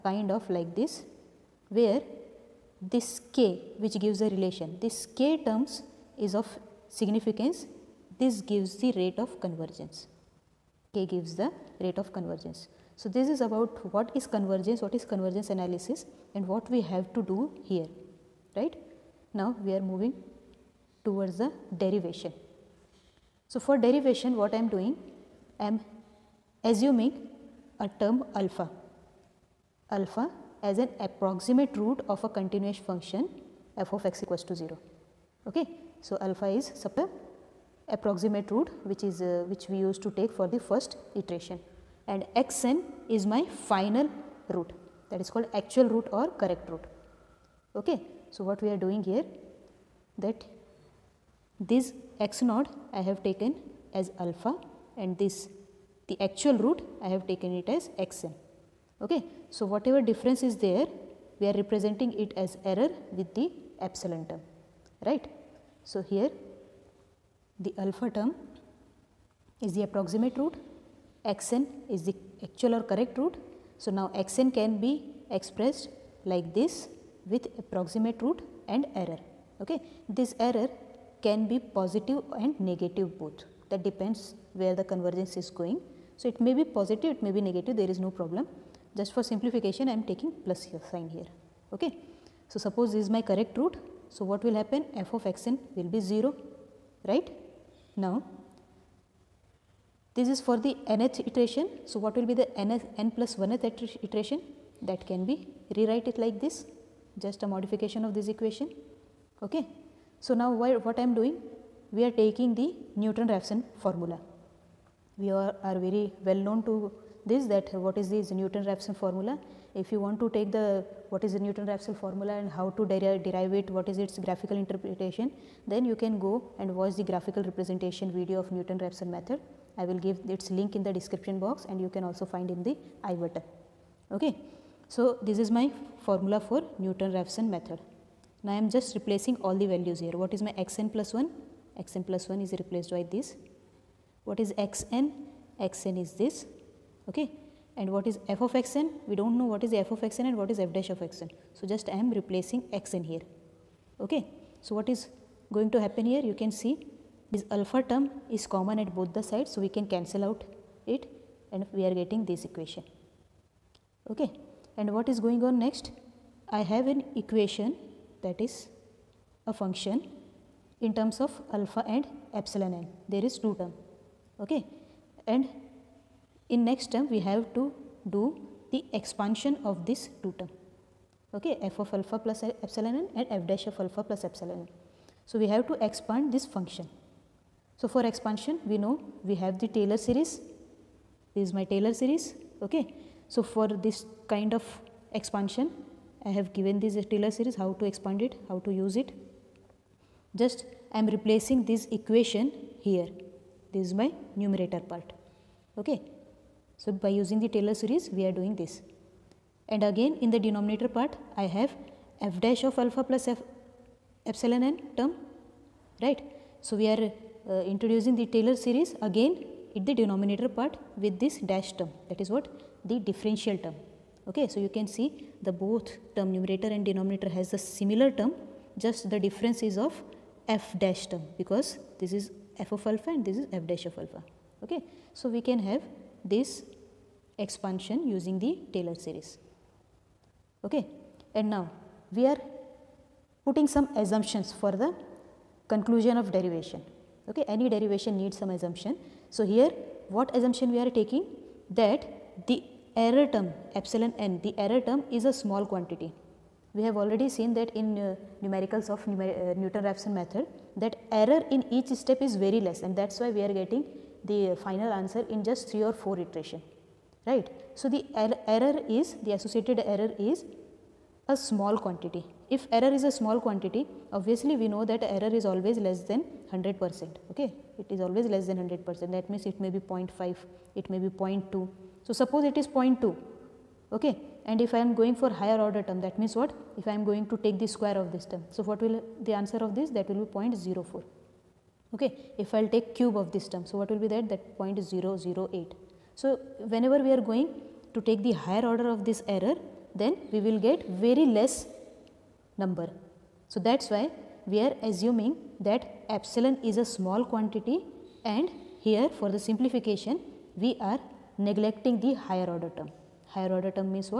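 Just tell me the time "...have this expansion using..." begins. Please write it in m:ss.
3:55.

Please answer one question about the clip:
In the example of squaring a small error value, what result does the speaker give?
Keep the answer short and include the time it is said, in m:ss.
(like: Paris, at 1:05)
0.04, at 4:50.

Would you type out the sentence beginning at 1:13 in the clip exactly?
So, now xn can be expressed like this with approximate root and error.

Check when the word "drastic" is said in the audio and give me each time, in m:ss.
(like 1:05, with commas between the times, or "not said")
not said.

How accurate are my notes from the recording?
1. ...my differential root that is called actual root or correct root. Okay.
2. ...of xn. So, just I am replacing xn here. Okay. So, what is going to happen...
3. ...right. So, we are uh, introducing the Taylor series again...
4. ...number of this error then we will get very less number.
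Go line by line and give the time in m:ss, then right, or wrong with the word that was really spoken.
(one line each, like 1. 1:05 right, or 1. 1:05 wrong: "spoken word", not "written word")
1. 0:43 wrong: "final", not "differential"
2. 2:30 right
3. 3:36 right
4. 4:58 wrong: "order", not "number".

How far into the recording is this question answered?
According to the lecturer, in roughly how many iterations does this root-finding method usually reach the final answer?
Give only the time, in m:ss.
4:25.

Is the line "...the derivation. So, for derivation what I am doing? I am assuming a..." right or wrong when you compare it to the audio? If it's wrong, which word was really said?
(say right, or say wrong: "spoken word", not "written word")
right.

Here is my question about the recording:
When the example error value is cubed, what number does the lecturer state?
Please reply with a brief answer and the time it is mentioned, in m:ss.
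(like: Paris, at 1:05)
0.008, at 4:54.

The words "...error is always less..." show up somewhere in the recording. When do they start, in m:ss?
4:35.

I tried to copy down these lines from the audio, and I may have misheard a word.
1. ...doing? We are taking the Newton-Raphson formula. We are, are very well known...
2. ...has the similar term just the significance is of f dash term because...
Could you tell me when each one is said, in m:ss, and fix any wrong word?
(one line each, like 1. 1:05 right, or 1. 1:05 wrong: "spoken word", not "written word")
1. 1:51 right
2. 3:47 wrong: "difference", not "significance".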